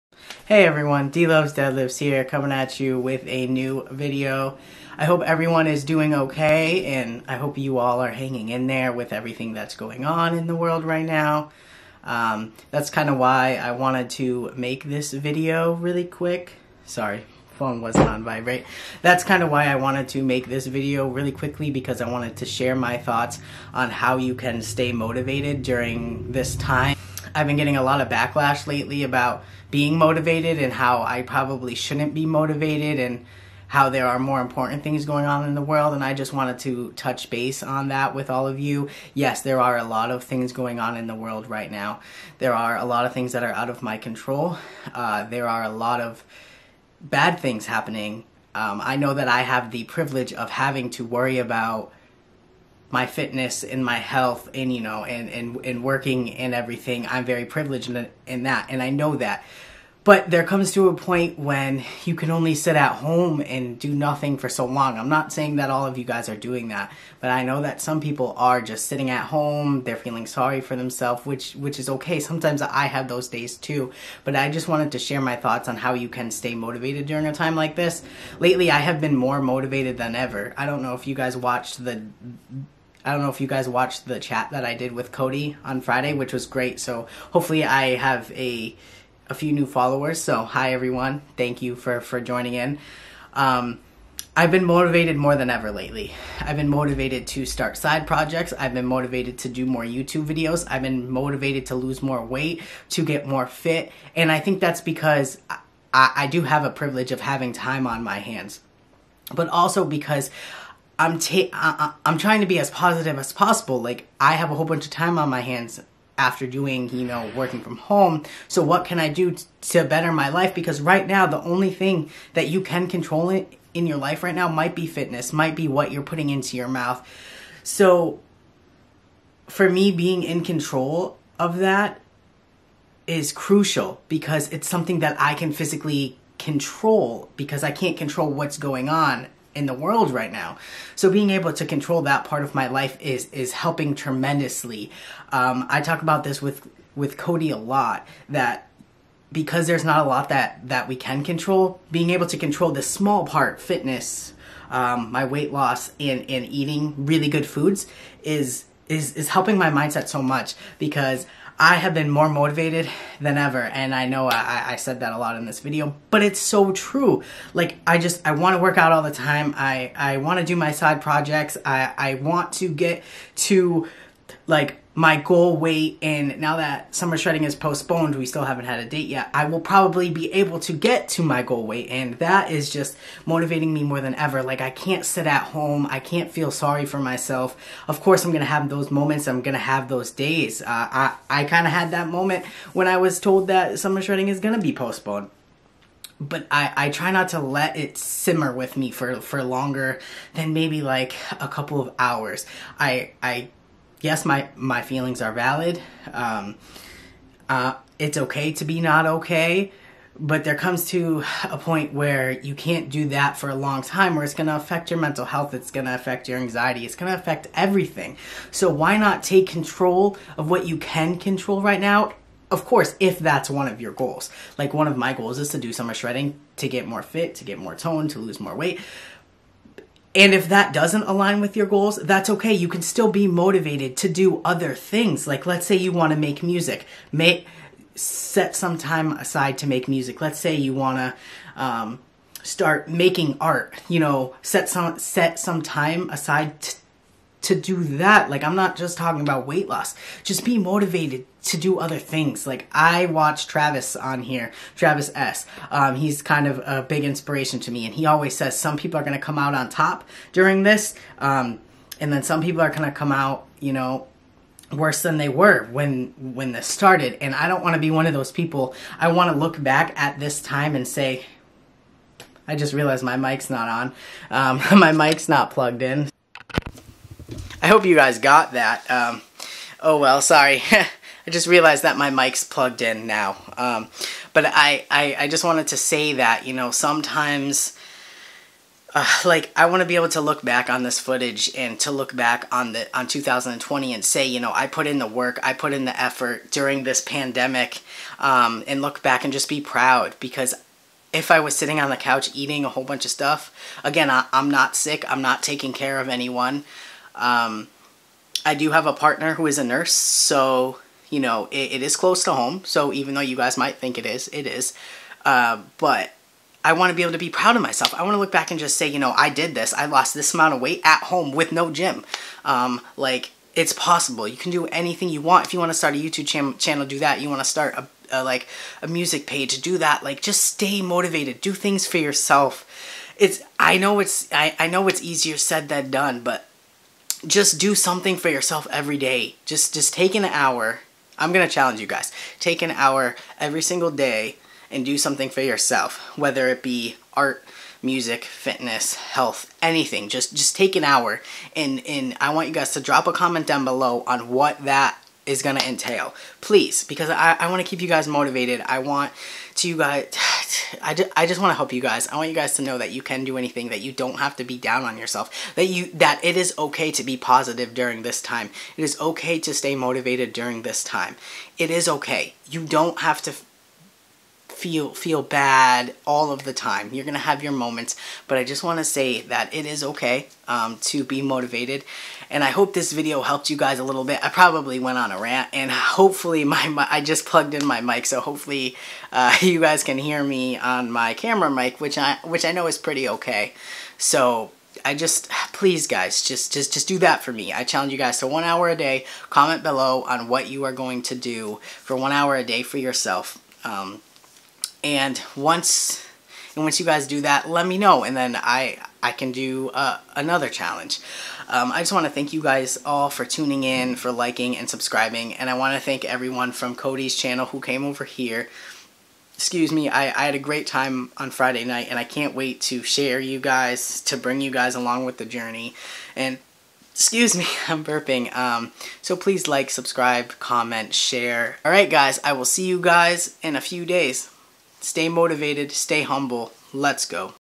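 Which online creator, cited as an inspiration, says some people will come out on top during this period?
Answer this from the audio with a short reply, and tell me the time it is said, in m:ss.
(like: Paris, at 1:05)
Travis S., at 4:14.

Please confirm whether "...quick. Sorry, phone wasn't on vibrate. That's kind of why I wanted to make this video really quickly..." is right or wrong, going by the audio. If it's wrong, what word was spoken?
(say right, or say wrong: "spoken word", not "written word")
right.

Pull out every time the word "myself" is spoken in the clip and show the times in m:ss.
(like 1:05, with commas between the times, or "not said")
3:06, 5:17.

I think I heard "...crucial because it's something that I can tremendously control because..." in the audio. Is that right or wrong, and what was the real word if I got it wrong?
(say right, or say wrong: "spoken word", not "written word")
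wrong: "physically", not "tremendously".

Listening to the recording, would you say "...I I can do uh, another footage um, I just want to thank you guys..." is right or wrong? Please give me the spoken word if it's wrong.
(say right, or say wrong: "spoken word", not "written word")
wrong: "challenge", not "footage".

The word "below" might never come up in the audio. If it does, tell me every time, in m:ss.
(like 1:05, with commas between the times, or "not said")
5:53, 6:39.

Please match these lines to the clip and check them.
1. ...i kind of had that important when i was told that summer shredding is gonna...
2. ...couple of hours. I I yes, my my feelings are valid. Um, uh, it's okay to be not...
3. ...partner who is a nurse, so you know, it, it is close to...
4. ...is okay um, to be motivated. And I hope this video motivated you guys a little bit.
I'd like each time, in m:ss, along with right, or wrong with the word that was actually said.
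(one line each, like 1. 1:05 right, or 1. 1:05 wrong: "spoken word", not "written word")
1. 3:11 wrong: "moment", not "important"
2. 3:21 right
3. 5:08 right
4. 6:19 wrong: "helped", not "motivated".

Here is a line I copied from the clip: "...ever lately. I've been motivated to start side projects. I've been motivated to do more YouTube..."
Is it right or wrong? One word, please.
right.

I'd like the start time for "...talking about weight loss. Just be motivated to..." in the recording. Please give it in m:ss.
4:08.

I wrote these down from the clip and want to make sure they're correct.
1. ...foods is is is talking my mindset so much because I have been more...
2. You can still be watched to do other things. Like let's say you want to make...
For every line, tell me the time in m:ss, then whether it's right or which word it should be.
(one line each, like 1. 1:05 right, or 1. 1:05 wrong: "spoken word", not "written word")
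1. 2:37 wrong: "helping", not "talking"
2. 3:52 wrong: "motivated", not "watched".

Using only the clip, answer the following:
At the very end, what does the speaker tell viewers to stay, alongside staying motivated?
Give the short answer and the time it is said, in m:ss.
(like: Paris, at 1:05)
Humble, at 7:15.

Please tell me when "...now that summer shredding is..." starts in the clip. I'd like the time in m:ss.
2:56.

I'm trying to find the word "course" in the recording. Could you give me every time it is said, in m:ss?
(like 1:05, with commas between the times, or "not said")
3:08, 3:42.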